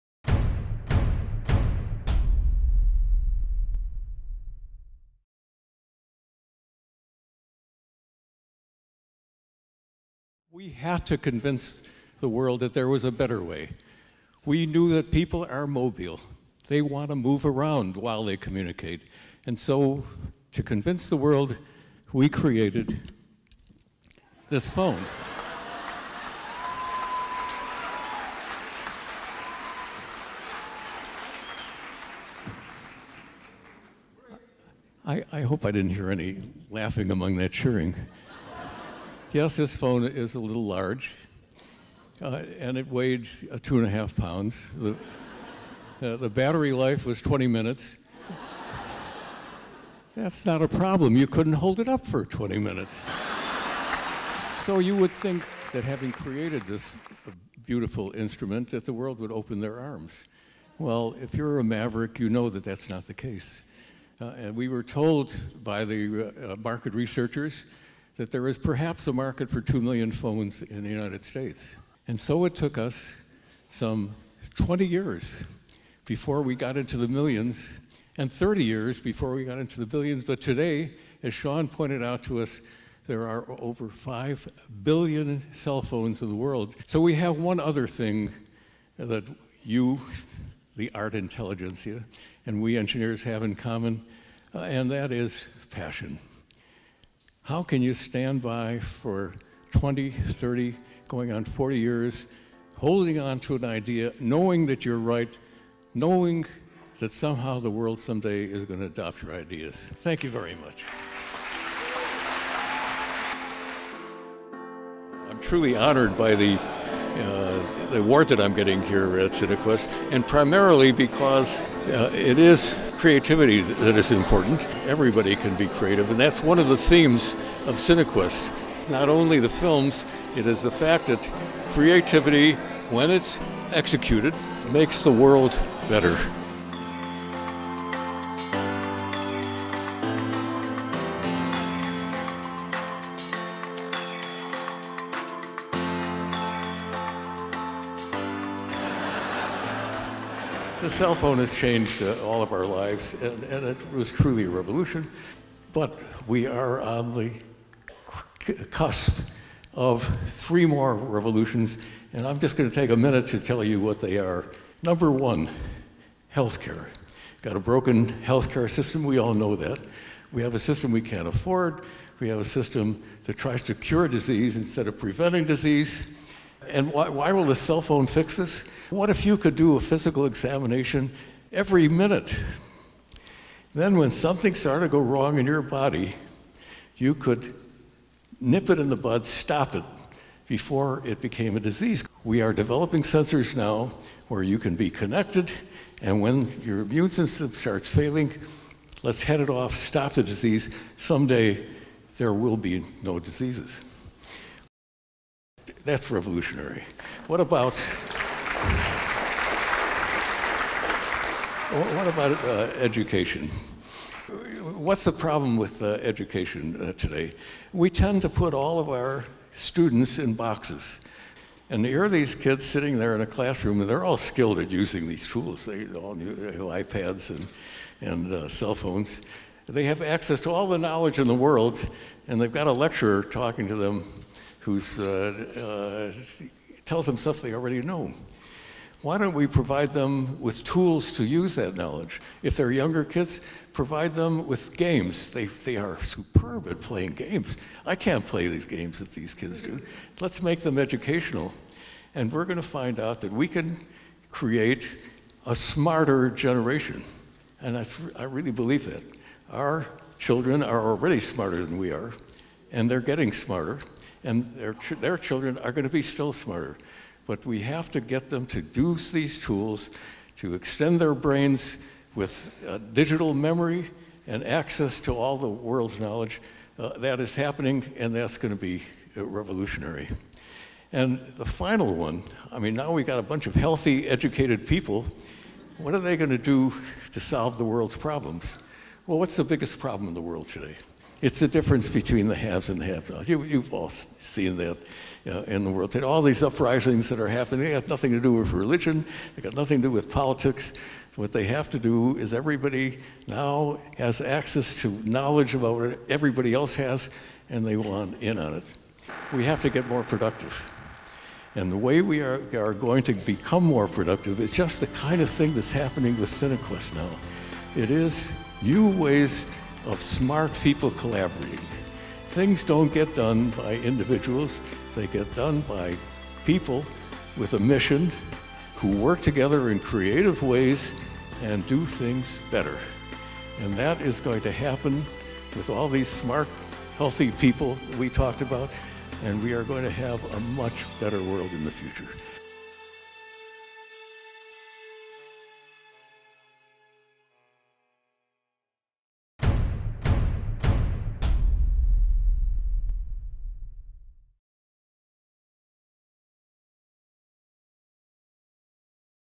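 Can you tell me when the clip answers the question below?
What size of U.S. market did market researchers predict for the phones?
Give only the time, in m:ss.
1:09.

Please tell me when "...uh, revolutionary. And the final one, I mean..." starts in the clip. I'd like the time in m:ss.
4:39.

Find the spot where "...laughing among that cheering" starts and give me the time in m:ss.
0:36.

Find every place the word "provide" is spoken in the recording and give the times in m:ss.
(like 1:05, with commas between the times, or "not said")
3:59, 4:03.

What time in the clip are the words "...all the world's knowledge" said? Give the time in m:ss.
4:35.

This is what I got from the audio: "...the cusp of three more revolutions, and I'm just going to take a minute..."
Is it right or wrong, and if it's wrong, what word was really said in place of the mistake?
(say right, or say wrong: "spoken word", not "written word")
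right.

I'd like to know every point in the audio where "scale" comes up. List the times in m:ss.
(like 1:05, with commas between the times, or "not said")
not said.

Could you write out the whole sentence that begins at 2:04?
Everybody can be creative, and that's one of the themes of Cinequest.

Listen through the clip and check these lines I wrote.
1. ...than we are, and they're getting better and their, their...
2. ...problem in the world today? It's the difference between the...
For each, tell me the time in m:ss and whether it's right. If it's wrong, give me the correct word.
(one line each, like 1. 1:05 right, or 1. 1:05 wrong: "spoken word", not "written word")
1. 4:21 wrong: "smarter", not "better"
2. 4:49 right.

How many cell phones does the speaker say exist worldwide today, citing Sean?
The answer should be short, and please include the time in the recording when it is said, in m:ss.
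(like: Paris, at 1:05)
over 5 billion, at 1:23.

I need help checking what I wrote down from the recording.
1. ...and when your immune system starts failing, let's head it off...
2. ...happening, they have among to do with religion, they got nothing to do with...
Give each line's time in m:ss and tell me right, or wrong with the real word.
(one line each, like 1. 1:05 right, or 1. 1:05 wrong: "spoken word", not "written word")
1. 3:16 right
2. 4:57 wrong: "nothing", not "among".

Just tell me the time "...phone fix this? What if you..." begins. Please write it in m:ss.
2:57.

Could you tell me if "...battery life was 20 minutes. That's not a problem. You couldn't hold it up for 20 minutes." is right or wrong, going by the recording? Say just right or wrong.
right.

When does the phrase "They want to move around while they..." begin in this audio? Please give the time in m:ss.
0:16.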